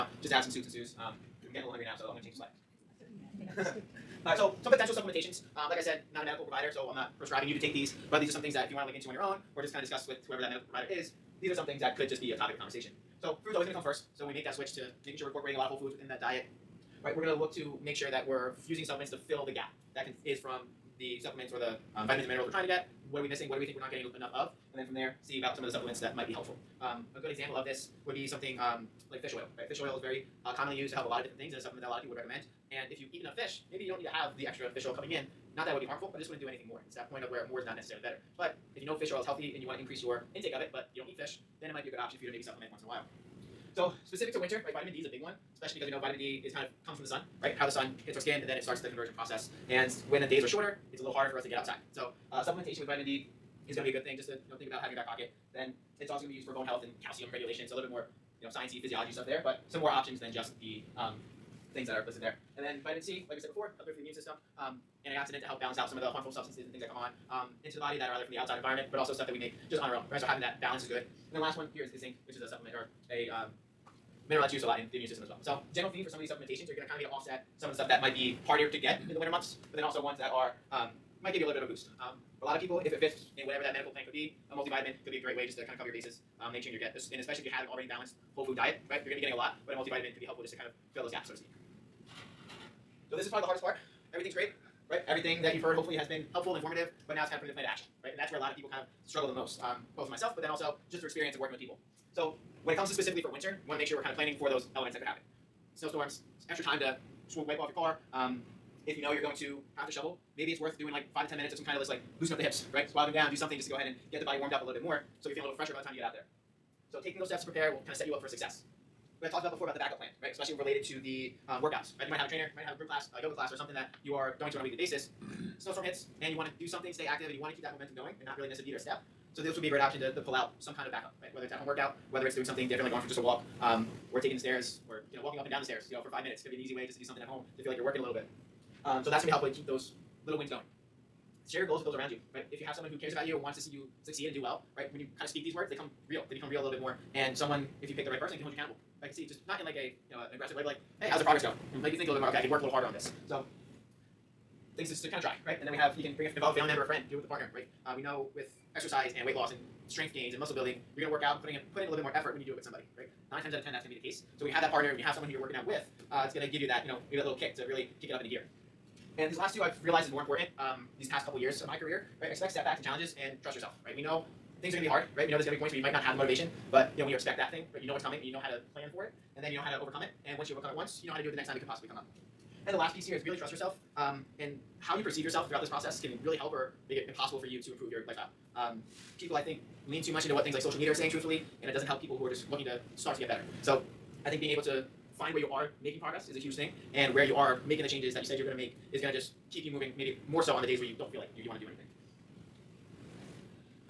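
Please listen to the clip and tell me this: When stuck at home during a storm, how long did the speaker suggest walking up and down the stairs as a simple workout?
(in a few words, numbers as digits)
5 minutes.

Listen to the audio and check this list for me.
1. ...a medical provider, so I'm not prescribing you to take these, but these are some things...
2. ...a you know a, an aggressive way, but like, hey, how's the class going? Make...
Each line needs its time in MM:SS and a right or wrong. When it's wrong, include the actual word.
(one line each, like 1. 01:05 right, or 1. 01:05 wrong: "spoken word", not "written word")
1. 00:06 right
2. 02:29 wrong: "progress", not "class".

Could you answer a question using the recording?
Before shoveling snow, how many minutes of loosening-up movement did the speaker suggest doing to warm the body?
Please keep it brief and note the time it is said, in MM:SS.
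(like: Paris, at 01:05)
5 to 10 minutes, at 01:51.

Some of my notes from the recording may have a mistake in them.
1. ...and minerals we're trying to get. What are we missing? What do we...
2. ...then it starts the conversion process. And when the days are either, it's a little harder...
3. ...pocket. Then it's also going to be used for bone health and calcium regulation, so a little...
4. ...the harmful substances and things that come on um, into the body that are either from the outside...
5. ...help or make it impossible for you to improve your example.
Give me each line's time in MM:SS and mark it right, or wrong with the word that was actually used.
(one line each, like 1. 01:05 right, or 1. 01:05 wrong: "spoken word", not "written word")
1. 00:22 right
2. 00:48 wrong: "shorter", not "either"
3. 00:55 right
4. 01:06 right
5. 03:06 wrong: "lifestyle", not "example".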